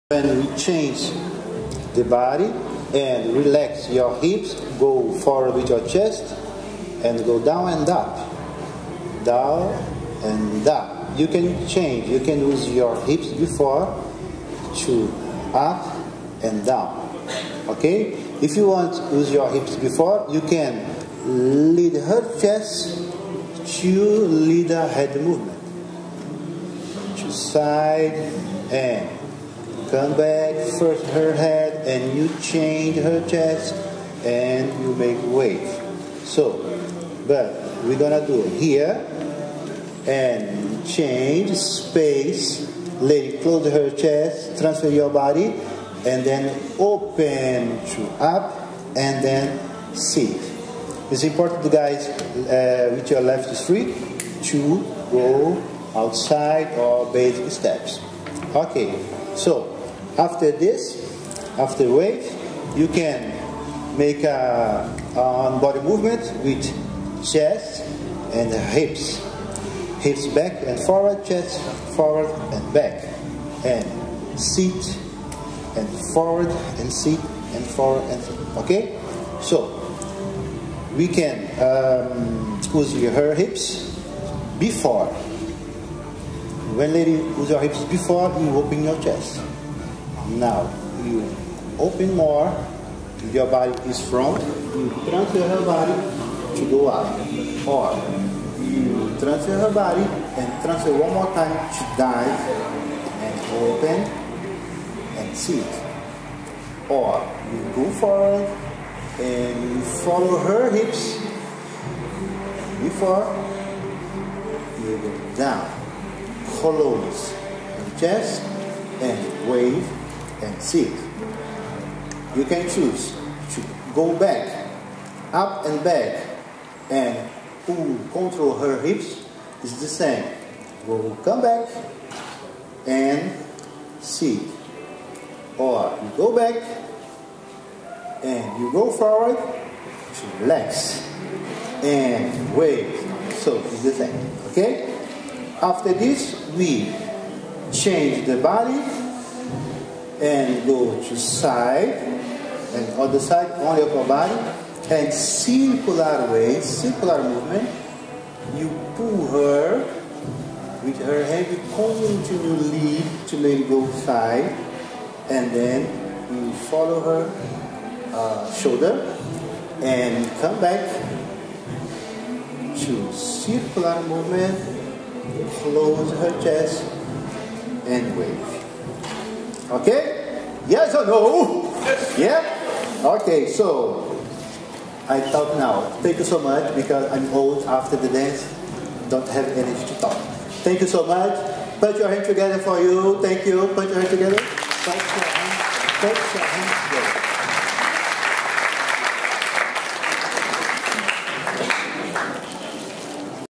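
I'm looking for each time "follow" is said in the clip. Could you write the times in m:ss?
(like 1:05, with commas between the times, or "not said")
1:49, 2:46.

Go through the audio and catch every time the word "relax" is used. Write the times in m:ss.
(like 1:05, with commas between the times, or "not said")
0:03, 2:20.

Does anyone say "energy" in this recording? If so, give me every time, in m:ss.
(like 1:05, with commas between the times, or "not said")
3:09.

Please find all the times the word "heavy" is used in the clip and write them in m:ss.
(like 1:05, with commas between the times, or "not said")
2:41.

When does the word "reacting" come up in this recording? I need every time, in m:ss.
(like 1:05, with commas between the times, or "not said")
not said.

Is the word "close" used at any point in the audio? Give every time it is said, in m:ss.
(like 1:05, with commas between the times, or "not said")
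0:43, 1:56, 2:55.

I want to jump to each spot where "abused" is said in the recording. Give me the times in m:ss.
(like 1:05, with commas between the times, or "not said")
not said.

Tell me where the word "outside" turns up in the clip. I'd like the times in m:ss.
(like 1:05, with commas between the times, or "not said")
0:55.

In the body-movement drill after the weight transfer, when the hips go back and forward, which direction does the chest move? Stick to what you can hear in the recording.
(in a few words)
Forward and back.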